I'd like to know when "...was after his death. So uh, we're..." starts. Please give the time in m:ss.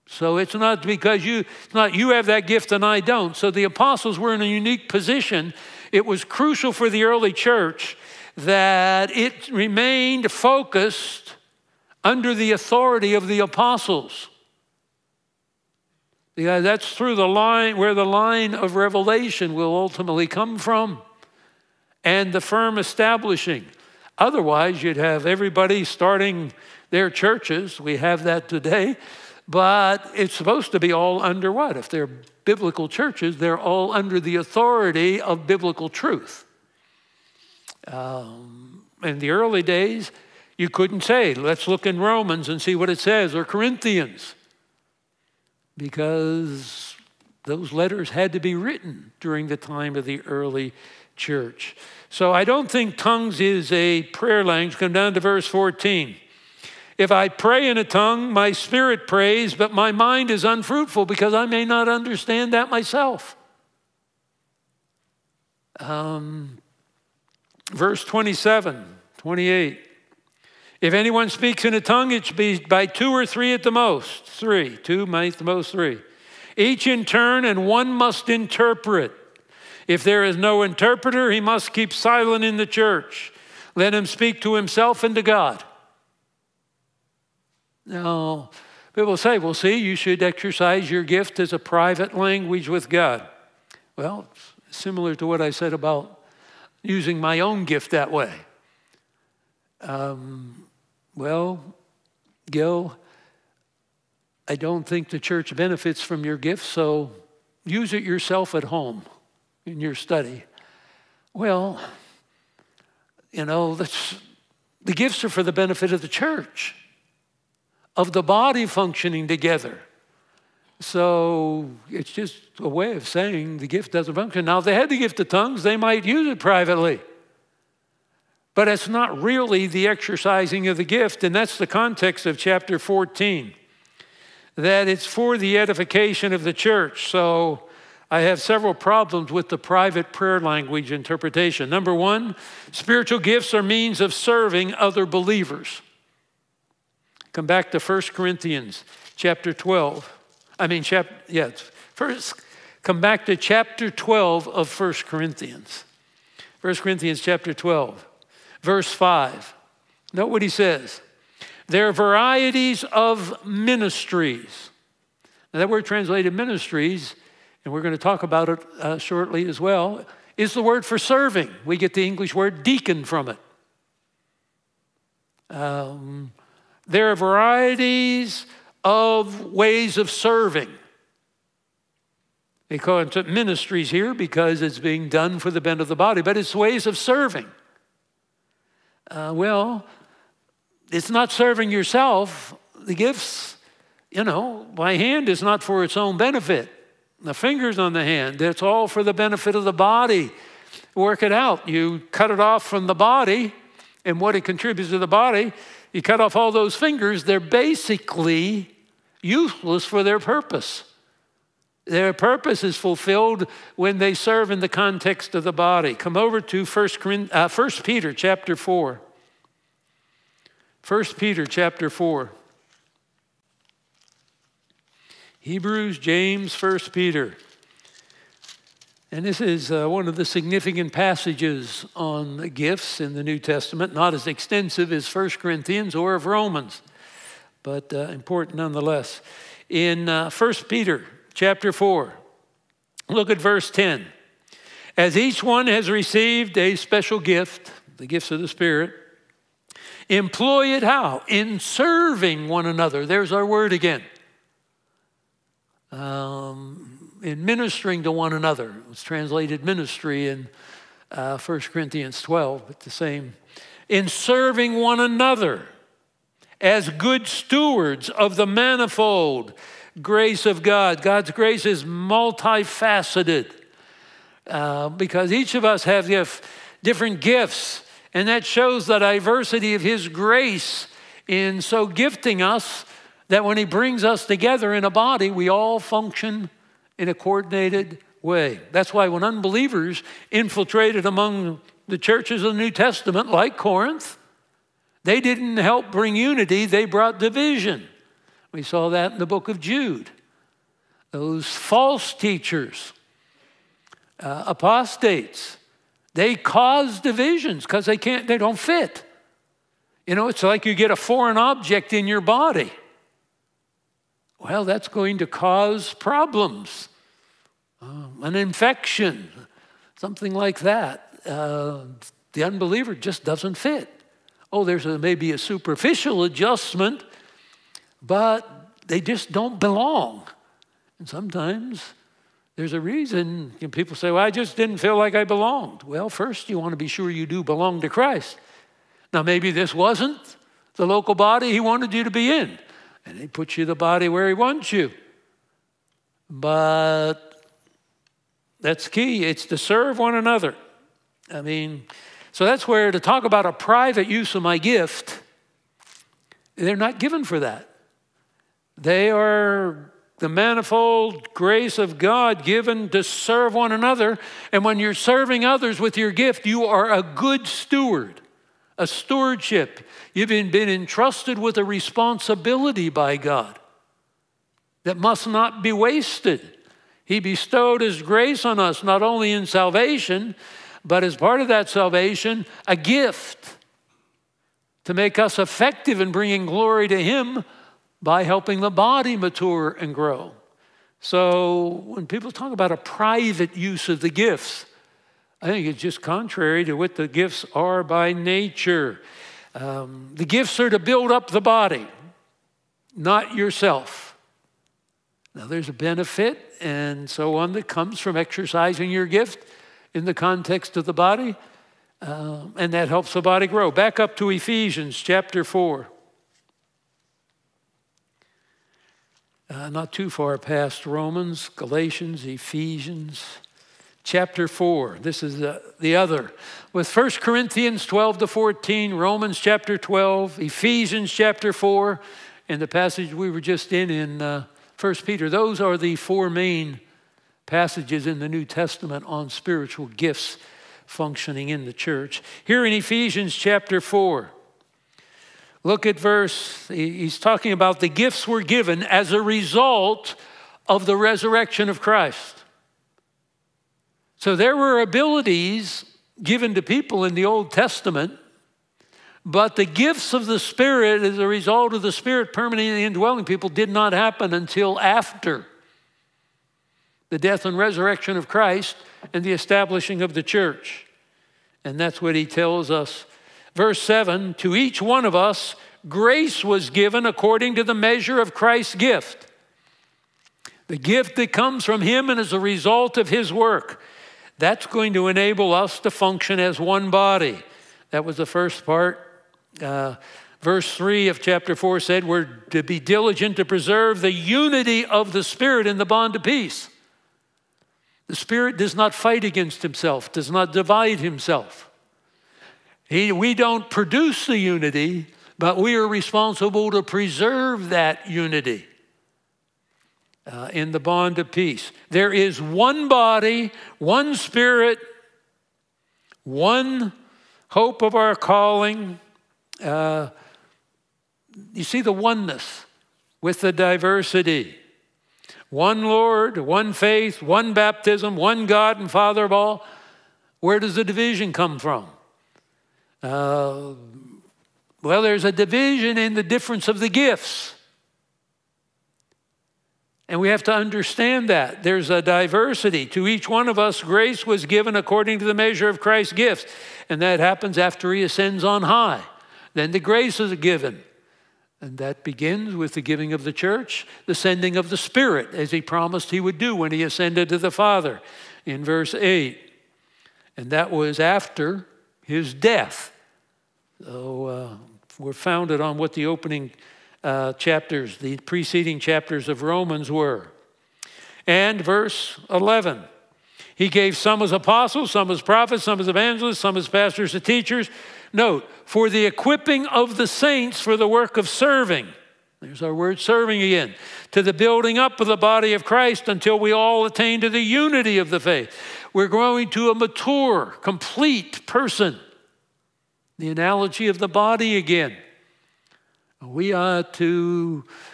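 9:20.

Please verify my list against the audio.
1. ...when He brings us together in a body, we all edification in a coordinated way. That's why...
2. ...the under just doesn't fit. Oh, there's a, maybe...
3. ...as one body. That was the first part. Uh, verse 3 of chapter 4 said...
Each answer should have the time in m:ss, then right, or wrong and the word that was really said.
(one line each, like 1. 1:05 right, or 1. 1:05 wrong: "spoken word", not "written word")
1. 4:43 wrong: "function", not "edification"
2. 5:22 wrong: "unbeliever", not "under"
3. 8:06 right.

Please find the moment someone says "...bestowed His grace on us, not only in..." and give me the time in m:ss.
6:17.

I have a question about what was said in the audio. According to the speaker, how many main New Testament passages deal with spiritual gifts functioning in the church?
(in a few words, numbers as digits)
4.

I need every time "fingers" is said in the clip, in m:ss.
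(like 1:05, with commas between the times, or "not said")
3:17, 3:26.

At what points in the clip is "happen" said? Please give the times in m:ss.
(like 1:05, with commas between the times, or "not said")
7:43, 9:07.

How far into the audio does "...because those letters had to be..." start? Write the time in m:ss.
0:45.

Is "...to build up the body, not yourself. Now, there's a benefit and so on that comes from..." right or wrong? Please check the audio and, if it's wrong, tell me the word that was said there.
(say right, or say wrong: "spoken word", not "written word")
right.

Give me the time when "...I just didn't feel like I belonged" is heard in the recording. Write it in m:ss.
5:34.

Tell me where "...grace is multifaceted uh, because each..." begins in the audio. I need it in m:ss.
4:31.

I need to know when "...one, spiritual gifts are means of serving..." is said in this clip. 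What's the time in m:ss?
2:21.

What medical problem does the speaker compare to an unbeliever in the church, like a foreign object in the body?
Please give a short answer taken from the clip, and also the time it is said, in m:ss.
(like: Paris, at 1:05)
an infection, at 5:18.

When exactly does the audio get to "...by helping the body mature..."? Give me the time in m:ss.
6:28.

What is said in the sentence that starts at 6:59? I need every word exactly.
Uh, not too far past Romans, Galatians, Ephesians chapter 4.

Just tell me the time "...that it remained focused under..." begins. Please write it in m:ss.
0:08.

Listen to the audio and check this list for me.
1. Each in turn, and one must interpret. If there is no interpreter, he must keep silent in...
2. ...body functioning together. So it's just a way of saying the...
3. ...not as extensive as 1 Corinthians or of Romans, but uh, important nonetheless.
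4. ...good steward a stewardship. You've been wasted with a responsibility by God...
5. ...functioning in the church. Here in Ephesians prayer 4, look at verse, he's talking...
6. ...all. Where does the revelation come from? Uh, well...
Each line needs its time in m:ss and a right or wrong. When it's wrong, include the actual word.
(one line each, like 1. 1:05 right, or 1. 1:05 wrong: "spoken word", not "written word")
1. 1:16 right
2. 1:58 right
3. 3:53 right
4. 6:07 wrong: "entrusted", not "wasted"
5. 7:20 wrong: "chapter", not "prayer"
6. 8:49 wrong: "division", not "revelation".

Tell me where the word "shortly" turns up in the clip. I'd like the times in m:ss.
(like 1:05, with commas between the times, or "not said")
2:48.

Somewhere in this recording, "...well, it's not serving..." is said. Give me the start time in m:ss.
3:09.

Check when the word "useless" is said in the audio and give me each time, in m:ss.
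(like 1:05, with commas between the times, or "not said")
3:29.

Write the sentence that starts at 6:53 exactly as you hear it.
Back up to Ephesians chapter 4.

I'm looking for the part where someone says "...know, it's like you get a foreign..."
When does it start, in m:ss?
5:10.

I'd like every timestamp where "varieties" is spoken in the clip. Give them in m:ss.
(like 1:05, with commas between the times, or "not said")
2:41, 2:57.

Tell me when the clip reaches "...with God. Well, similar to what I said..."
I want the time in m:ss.
1:32.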